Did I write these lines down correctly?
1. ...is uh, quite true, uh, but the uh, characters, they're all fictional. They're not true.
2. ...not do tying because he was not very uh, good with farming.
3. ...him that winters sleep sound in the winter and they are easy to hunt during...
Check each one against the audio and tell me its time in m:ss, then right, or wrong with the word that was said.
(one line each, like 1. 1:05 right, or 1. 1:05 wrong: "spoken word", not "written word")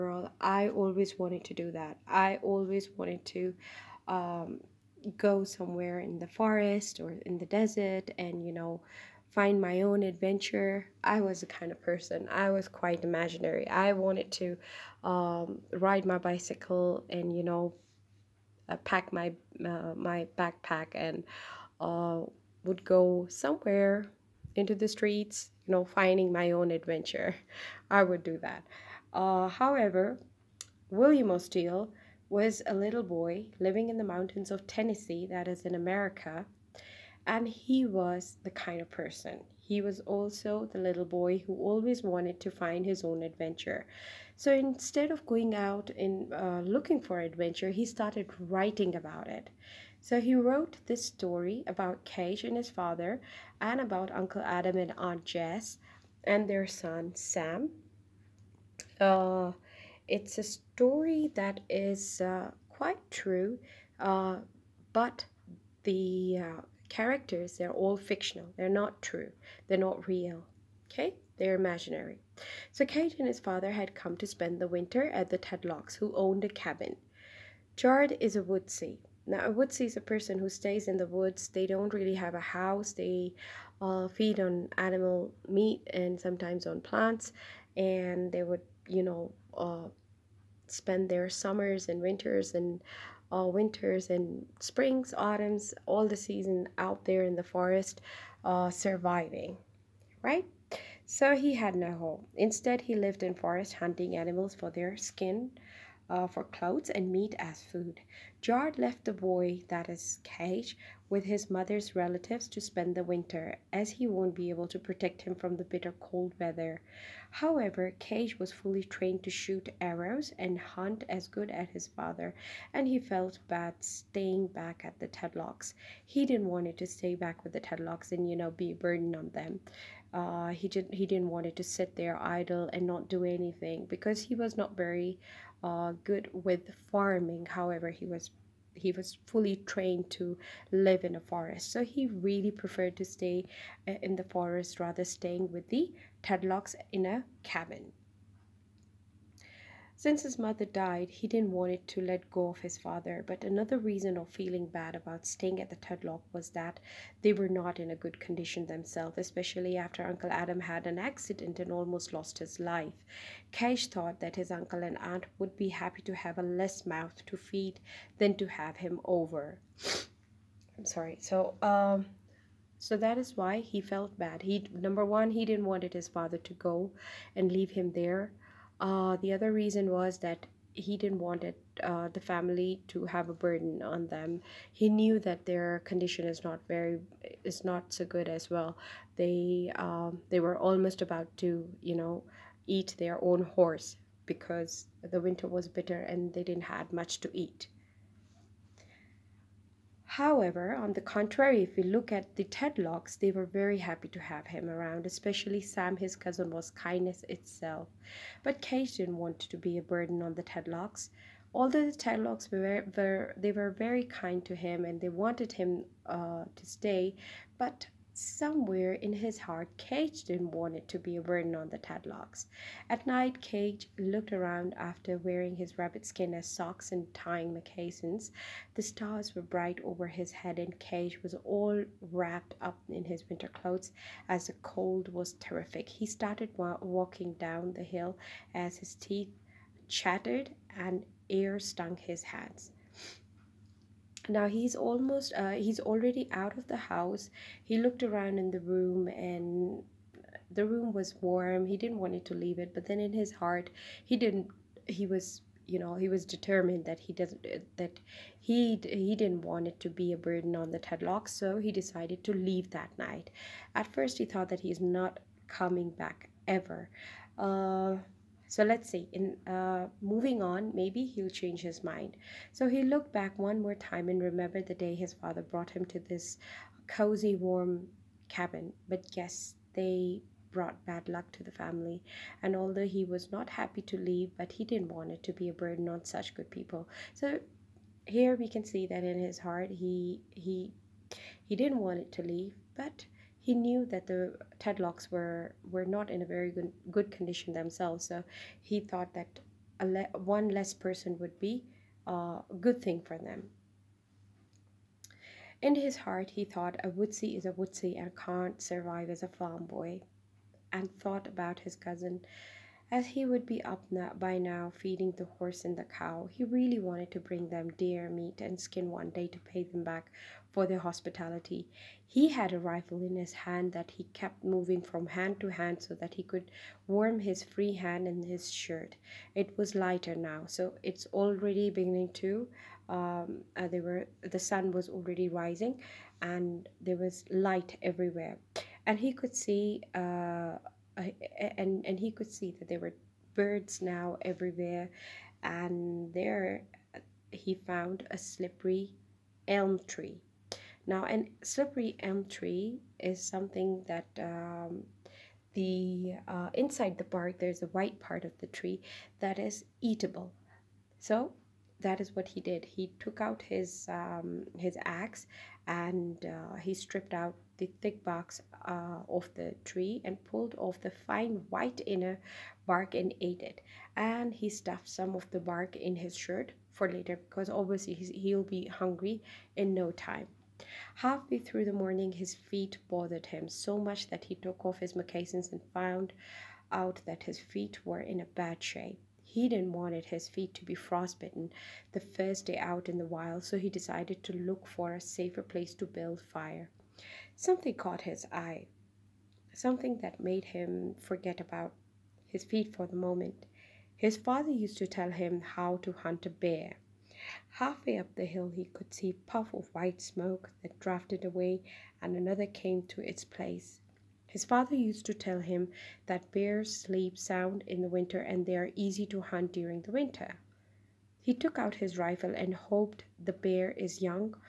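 1. 1:01 right
2. 2:12 wrong: "anything", not "tying"
3. 6:55 wrong: "bears", not "winters".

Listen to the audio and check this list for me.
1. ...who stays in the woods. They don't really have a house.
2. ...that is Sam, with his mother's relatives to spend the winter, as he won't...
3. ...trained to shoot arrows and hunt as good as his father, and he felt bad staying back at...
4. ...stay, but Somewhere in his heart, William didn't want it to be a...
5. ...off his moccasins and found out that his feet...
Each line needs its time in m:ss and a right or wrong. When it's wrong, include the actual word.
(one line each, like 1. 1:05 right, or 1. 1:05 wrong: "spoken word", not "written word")
1. 1:20 right
2. 1:49 wrong: "Cage", not "Sam"
3. 1:58 right
4. 3:36 wrong: "Cage", not "William"
5. 6:24 right.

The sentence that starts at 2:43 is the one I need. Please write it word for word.
Cage thought that his uncle and aunt would be happy to have a less mouth to feed than to have him over.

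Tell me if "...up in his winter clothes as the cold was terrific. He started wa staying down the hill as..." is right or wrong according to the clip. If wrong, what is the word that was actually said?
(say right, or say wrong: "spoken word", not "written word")
wrong: "walking", not "staying".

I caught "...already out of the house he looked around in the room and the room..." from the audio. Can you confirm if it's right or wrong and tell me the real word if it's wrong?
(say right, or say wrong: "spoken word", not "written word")
right.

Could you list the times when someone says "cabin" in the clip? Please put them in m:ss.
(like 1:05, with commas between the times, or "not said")
1:16, 2:27, 4:38.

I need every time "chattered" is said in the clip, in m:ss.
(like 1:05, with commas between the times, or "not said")
3:59.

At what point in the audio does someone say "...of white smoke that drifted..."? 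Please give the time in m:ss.
6:49.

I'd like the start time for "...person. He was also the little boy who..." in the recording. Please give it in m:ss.
0:38.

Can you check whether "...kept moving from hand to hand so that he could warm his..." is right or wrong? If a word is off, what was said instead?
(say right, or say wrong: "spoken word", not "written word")
right.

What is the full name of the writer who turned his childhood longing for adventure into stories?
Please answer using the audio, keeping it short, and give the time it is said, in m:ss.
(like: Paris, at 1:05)
William O. Steele, at 0:30.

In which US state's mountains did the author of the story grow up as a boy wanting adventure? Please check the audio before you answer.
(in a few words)
Tennessee.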